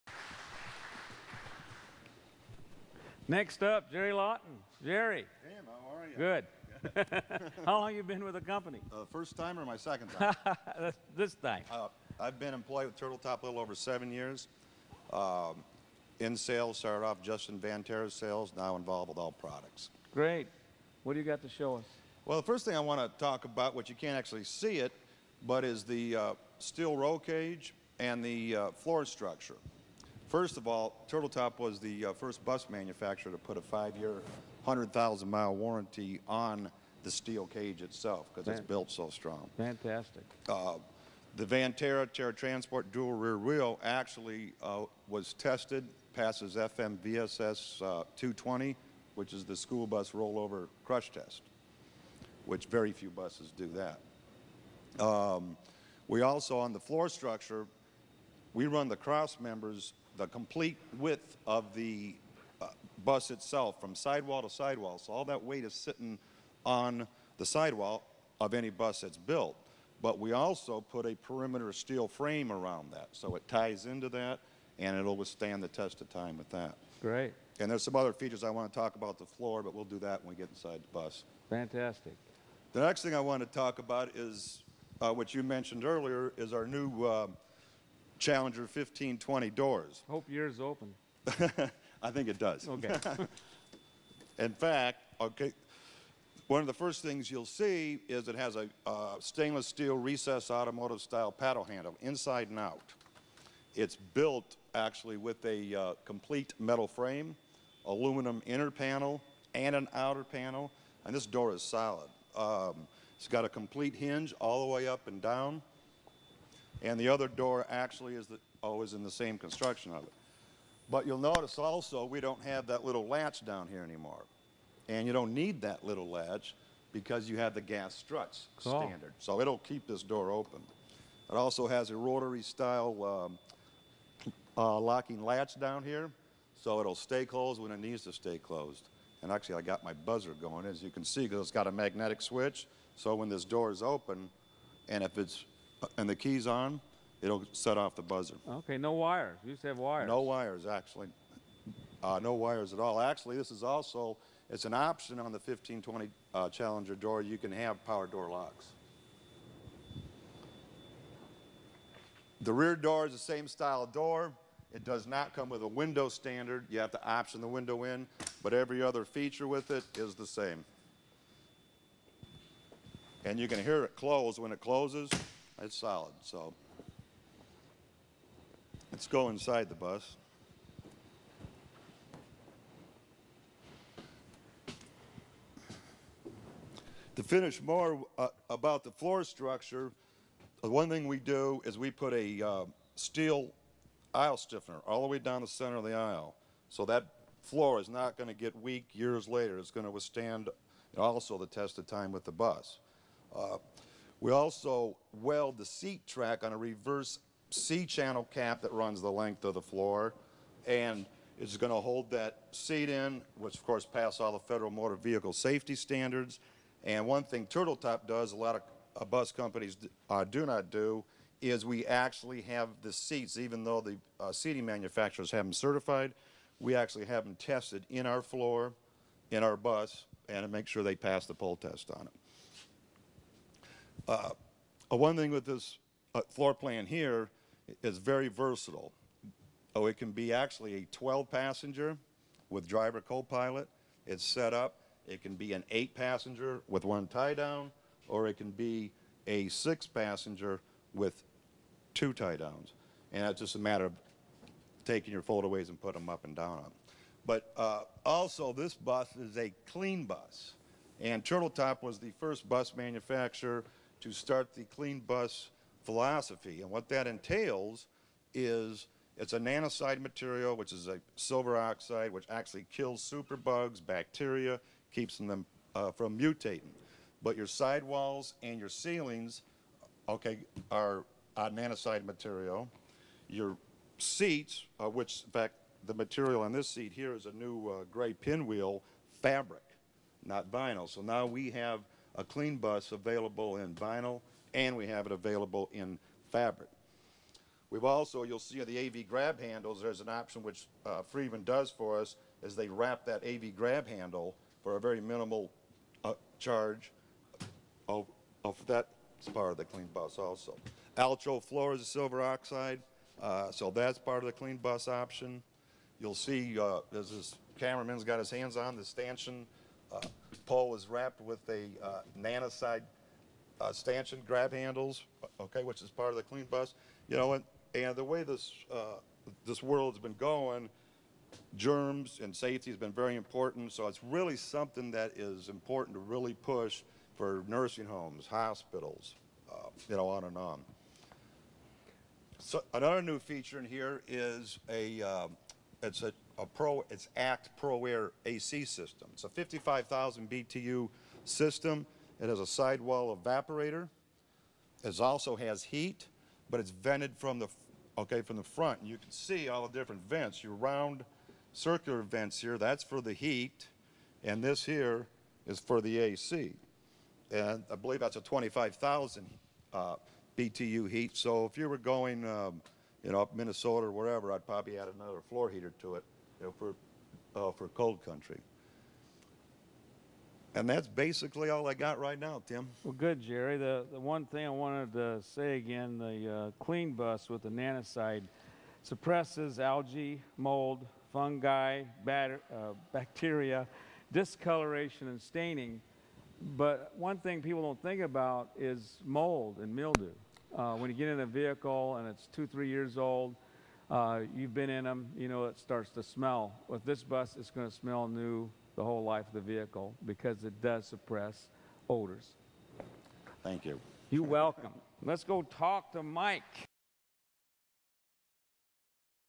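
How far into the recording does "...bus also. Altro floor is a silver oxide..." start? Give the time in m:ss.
5:09.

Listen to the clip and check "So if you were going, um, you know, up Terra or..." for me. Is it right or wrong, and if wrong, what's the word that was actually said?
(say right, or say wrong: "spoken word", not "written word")
wrong: "Minnesota", not "Terra".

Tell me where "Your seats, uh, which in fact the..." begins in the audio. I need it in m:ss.
4:43.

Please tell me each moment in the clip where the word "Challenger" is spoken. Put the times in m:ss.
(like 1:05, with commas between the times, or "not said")
1:28, 2:36.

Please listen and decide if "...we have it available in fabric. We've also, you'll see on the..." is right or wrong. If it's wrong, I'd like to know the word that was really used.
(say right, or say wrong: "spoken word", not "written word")
right.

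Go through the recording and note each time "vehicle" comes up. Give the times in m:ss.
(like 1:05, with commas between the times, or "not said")
3:34, 6:41, 6:49.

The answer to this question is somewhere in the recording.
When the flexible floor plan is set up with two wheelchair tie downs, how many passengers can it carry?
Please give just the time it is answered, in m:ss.
4:09.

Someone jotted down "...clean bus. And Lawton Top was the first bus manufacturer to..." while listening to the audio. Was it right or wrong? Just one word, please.
wrong.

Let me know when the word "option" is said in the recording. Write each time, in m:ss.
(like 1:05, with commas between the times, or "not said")
2:34, 2:47, 5:00, 5:14.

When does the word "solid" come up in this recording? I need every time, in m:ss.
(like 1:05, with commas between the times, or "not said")
1:51, 2:55.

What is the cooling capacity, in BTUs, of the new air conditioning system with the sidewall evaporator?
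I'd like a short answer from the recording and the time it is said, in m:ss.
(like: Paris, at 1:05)
55,000 BTU, at 5:49.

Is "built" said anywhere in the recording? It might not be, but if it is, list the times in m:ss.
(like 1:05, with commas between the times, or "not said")
0:38, 1:09, 1:43.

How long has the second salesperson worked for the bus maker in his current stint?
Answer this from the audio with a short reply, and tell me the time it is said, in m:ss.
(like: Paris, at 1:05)
a little over 7 years, at 0:13.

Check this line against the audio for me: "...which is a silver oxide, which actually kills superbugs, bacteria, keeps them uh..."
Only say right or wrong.
right.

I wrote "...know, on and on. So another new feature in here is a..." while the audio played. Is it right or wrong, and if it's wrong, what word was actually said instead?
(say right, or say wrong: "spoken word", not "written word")
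right.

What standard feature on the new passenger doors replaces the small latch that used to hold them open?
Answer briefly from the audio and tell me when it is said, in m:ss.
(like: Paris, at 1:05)
gas struts, at 2:07.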